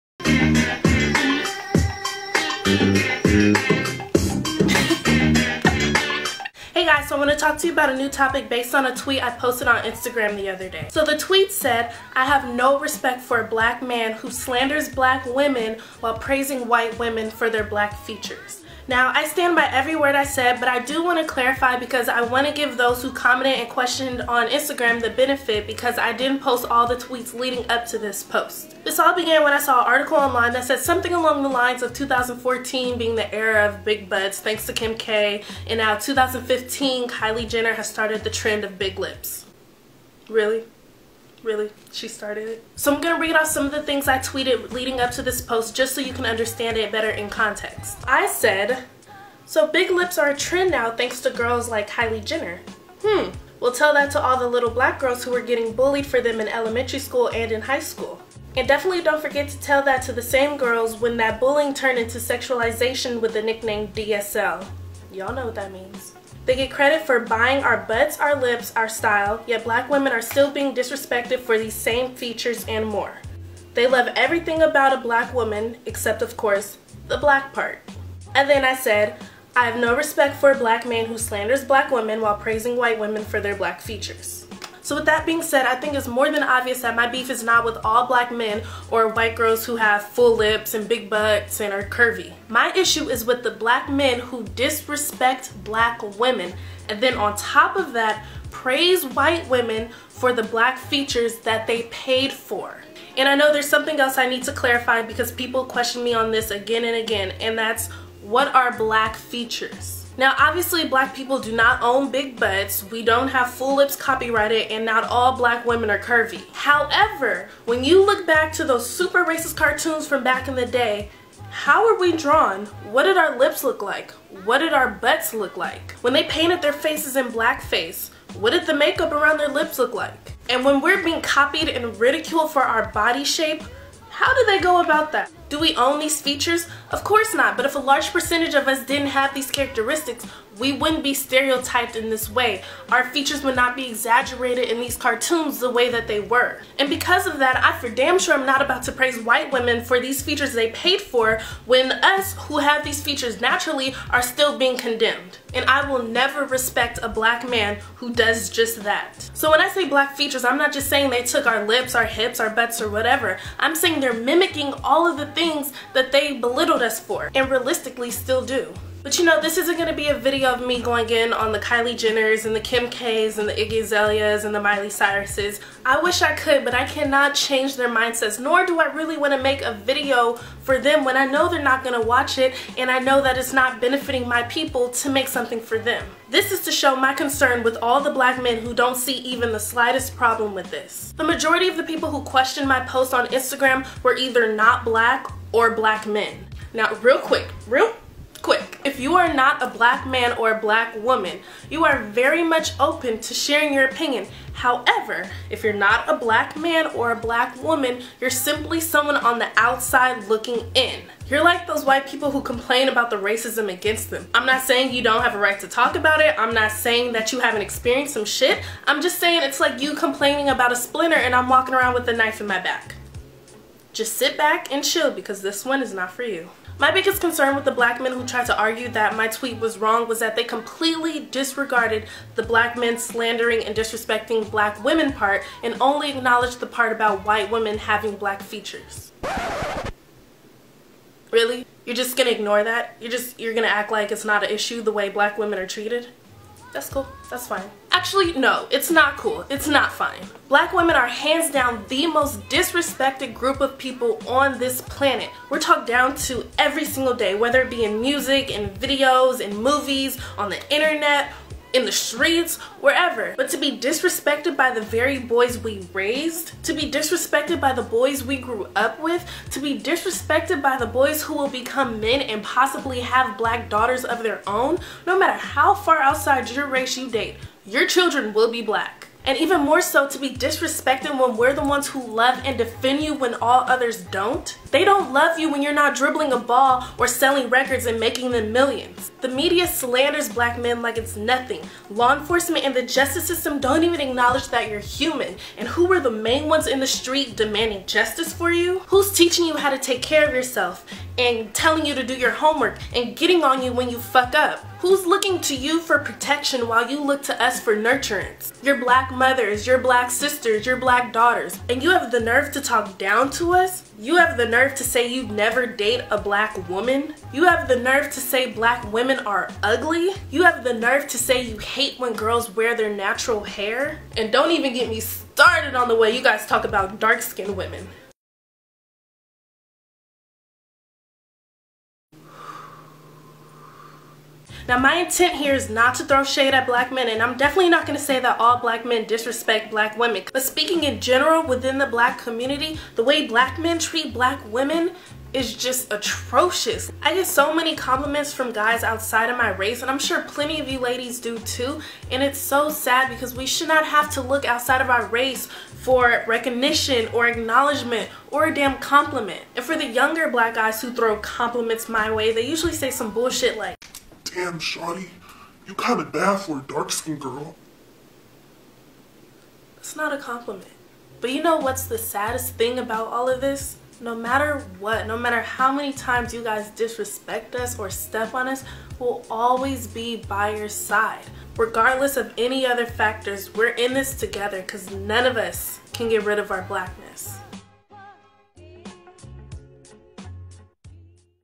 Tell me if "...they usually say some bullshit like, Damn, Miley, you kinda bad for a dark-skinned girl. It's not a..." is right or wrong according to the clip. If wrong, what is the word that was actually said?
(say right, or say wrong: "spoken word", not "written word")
wrong: "Shawty", not "Miley".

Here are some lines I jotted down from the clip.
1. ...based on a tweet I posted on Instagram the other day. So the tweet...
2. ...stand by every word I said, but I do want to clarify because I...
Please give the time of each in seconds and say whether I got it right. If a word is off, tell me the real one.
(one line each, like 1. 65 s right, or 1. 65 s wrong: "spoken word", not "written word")
1. 8 s right
2. 19 s right.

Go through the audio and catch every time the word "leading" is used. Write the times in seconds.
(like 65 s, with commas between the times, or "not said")
27 s, 44 s.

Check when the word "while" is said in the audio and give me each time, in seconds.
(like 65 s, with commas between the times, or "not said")
15 s, 82 s, 306 s.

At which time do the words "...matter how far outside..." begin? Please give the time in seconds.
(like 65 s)
275 s.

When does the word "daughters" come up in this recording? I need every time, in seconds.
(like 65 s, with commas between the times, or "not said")
273 s, 311 s.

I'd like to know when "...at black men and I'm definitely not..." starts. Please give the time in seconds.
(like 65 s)
336 s.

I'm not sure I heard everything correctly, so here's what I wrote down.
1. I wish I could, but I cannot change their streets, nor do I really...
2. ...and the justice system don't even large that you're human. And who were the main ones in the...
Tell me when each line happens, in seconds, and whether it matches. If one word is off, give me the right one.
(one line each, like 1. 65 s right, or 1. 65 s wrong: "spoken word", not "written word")
1. 175 s wrong: "mindsets", not "streets"
2. 292 s wrong: "acknowledge", not "large".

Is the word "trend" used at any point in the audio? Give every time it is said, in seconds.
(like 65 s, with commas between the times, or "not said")
38 s, 50 s.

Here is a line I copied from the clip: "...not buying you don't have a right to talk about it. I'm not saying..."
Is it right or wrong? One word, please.
wrong.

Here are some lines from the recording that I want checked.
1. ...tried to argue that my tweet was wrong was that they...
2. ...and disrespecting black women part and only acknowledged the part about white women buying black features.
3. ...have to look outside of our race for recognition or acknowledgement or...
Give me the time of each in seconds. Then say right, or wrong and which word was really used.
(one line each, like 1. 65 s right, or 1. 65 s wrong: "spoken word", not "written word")
1. 228 s right
2. 233 s wrong: "having", not "buying"
3. 353 s right.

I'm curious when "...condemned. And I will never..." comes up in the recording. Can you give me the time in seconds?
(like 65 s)
154 s.